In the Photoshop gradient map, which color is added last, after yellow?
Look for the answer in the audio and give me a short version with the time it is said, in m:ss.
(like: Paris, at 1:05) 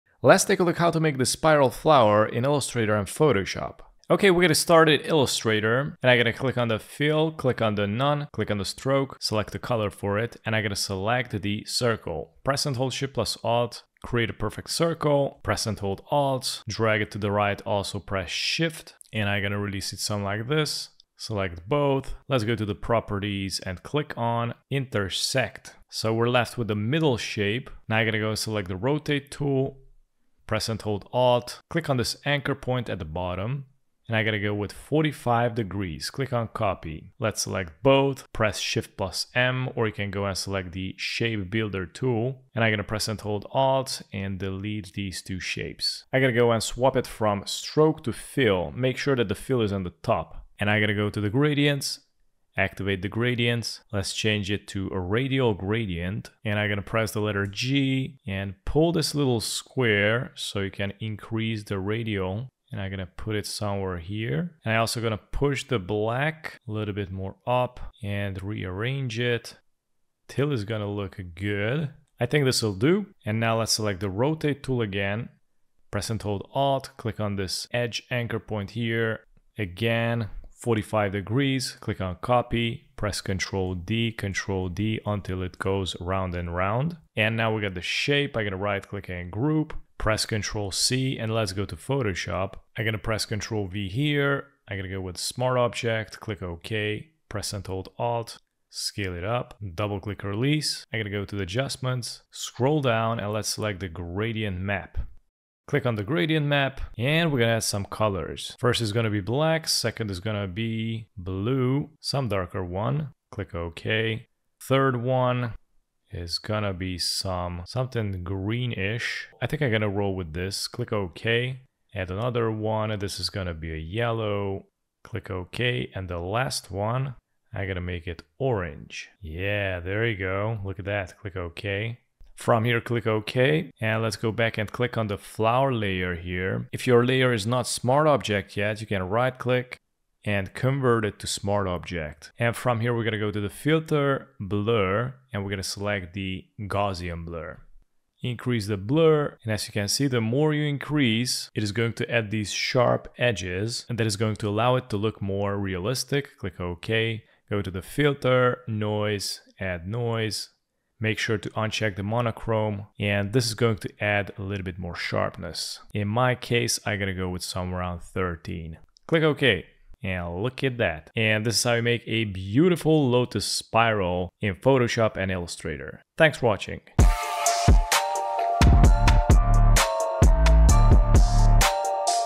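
orange, at 2:08.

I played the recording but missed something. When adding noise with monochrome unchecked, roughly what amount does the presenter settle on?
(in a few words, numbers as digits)
13.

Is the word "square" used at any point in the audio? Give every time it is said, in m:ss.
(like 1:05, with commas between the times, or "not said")
0:59.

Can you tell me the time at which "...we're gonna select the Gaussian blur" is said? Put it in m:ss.
2:25.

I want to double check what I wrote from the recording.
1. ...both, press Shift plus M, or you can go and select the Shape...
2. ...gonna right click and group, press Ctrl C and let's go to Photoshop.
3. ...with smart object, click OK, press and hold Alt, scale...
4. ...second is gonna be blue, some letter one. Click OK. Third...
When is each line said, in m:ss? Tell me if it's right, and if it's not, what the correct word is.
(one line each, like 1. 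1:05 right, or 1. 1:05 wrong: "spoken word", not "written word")
1. 0:37 right
2. 1:28 right
3. 1:35 right
4. 1:49 wrong: "darker", not "letter".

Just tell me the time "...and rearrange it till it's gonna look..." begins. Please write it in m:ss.
1:08.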